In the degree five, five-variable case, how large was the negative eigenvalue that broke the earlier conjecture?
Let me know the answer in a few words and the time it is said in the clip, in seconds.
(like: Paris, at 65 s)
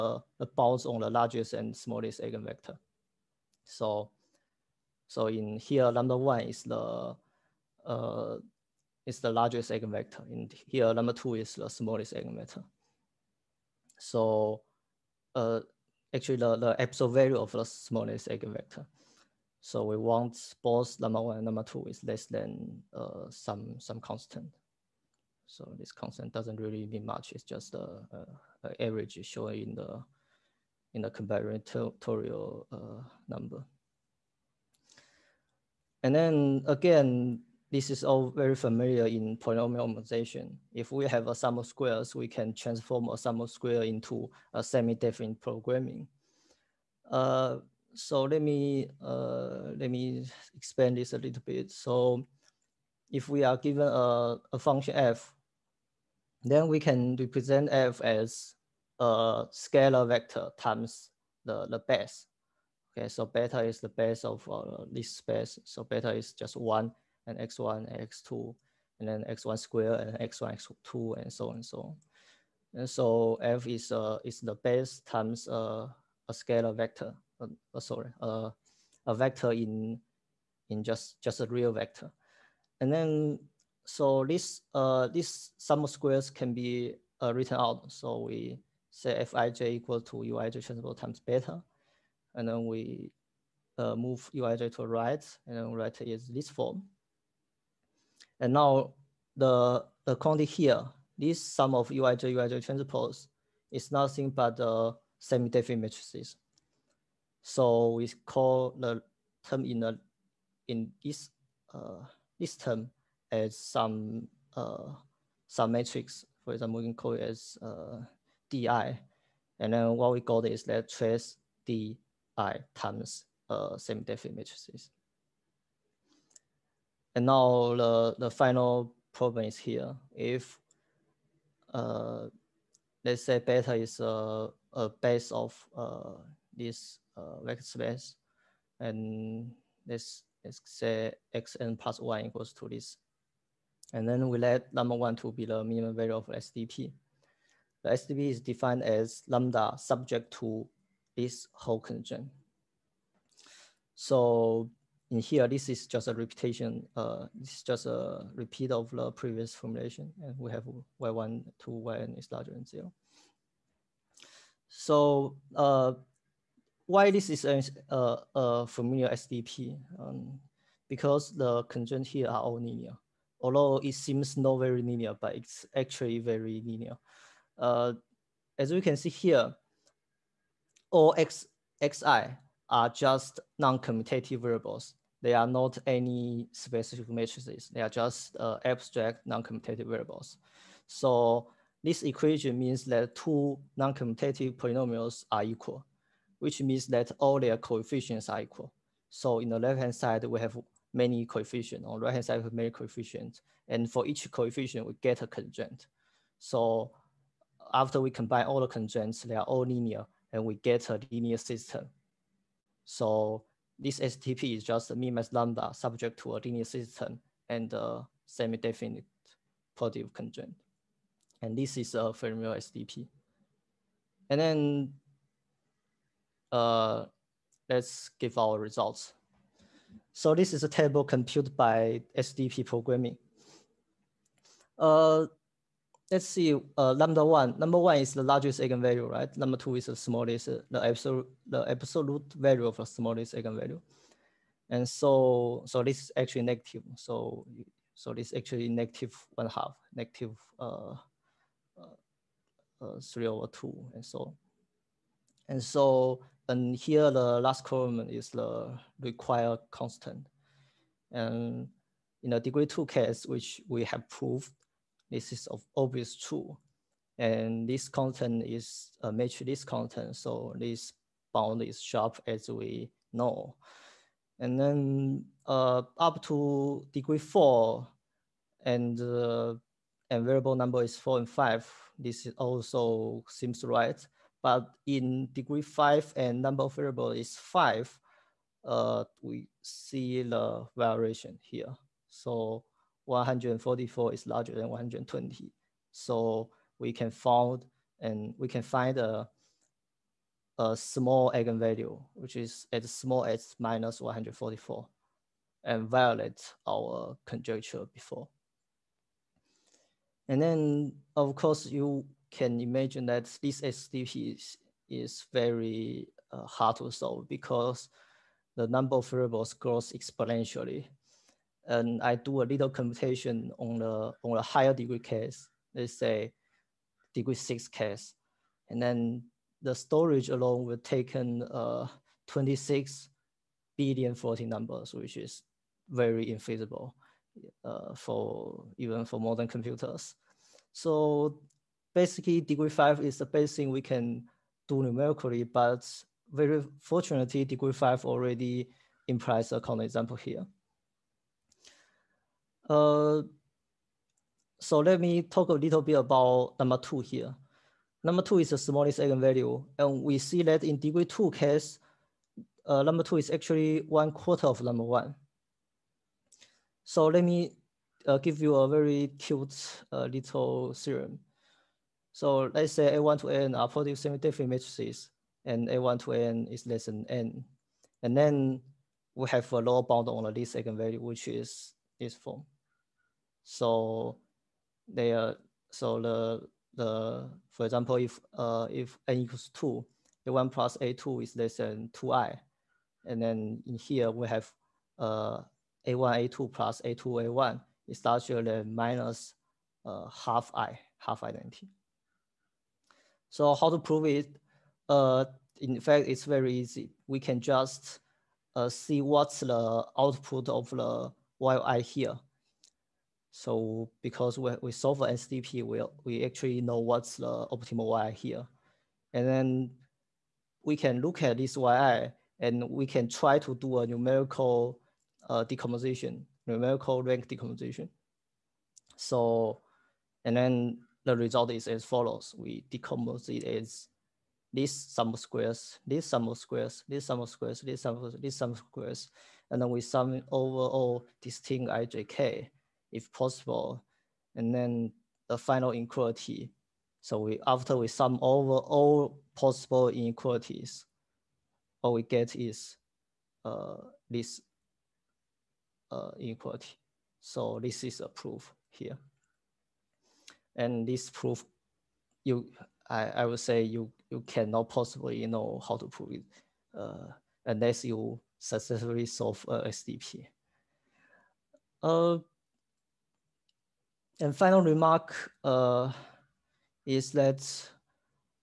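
144, at 303 s.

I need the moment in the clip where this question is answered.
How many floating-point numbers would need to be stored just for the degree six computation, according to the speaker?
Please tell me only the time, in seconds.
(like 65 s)
332 s.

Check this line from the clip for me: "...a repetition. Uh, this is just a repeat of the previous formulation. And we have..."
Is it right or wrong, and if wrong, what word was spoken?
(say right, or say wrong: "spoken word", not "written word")
right.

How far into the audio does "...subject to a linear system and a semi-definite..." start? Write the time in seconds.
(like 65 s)
215 s.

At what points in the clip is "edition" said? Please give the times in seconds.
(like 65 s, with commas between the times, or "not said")
not said.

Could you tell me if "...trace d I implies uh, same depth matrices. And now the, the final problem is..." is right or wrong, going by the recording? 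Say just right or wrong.
wrong.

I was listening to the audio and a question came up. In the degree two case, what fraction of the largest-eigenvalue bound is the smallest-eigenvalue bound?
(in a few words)
one quarter.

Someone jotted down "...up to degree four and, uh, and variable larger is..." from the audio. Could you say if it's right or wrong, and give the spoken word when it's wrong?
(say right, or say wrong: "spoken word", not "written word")
wrong: "number", not "larger".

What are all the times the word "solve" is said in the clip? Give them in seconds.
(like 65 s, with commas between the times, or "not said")
316 s, 414 s, 469 s.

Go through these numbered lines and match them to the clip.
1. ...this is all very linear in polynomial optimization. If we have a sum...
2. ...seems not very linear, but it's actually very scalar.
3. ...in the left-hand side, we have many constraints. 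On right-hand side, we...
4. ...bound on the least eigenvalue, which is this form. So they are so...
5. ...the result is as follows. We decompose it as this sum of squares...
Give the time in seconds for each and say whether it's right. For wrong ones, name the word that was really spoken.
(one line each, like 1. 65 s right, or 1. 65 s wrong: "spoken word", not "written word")
1. 37 s wrong: "familiar", not "linear"
2. 173 s wrong: "linear", not "scalar"
3. 199 s wrong: "coefficients", not "constraints"
4. 379 s right
5. 431 s right.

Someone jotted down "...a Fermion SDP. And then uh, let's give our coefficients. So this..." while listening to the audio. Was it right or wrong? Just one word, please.
wrong.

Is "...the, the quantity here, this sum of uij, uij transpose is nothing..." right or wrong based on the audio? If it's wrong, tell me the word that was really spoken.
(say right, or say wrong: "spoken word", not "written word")
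right.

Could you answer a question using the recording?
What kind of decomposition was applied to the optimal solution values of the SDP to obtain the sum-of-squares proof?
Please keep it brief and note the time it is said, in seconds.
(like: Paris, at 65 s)
numerical rank decomposition, at 426 s.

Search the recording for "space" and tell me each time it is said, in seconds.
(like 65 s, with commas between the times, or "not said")
65 s, 137 s.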